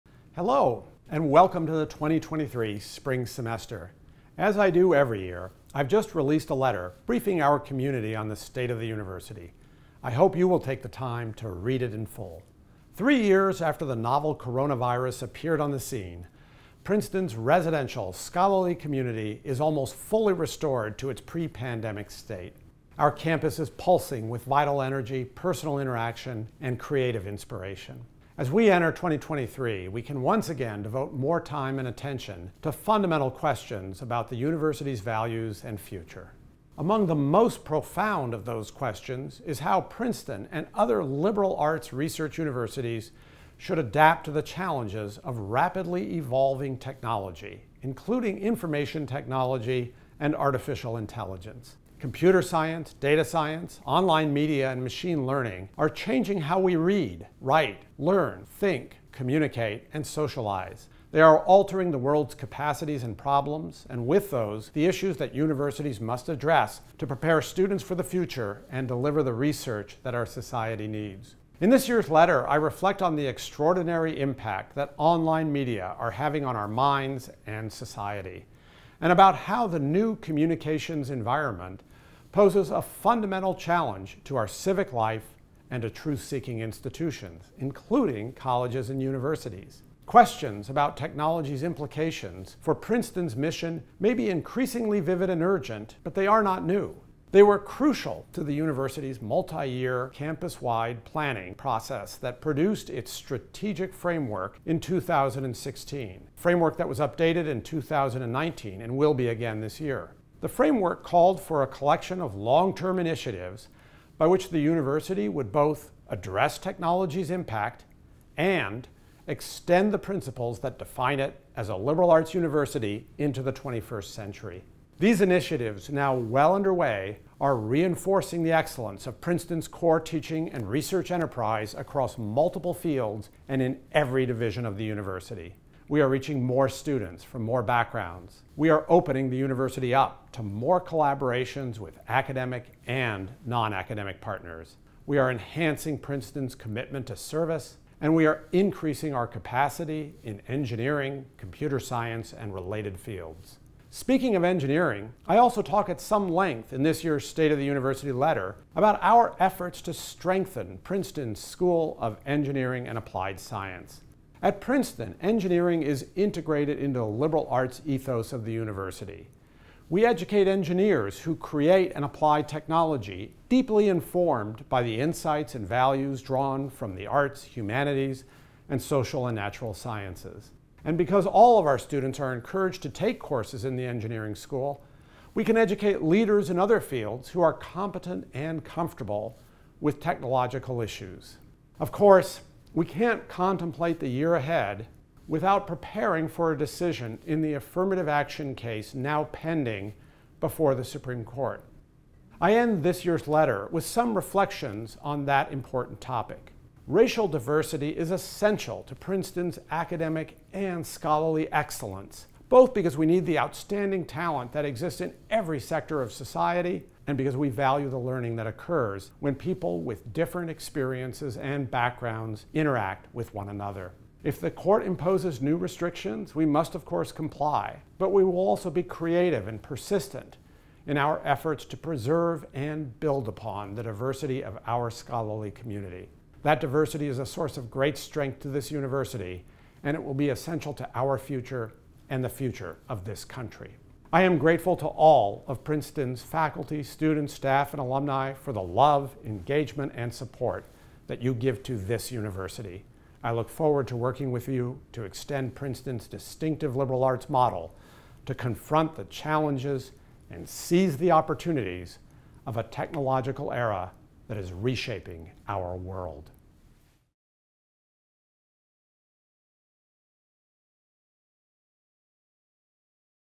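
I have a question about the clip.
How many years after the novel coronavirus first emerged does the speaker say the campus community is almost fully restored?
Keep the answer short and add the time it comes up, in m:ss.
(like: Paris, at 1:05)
3, at 0:12.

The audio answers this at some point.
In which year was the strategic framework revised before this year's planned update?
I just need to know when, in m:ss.
1:47.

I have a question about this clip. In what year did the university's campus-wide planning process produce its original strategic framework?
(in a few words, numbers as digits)
2016.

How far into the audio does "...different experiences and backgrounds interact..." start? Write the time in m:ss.
3:40.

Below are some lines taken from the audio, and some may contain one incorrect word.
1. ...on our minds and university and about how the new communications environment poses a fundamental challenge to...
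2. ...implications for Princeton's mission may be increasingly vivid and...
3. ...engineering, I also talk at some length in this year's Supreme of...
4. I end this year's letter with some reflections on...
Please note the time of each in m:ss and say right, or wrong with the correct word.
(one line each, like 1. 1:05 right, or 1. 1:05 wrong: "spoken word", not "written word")
1. 1:16 wrong: "society", not "university"
2. 1:31 right
3. 2:34 wrong: "State", not "Supreme"
4. 3:22 right.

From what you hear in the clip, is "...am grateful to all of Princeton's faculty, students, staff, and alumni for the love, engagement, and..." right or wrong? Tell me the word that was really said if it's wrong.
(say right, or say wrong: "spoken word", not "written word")
right.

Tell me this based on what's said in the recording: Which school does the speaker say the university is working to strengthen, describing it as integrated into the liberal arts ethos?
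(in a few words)
School of Engineering and Applied Science.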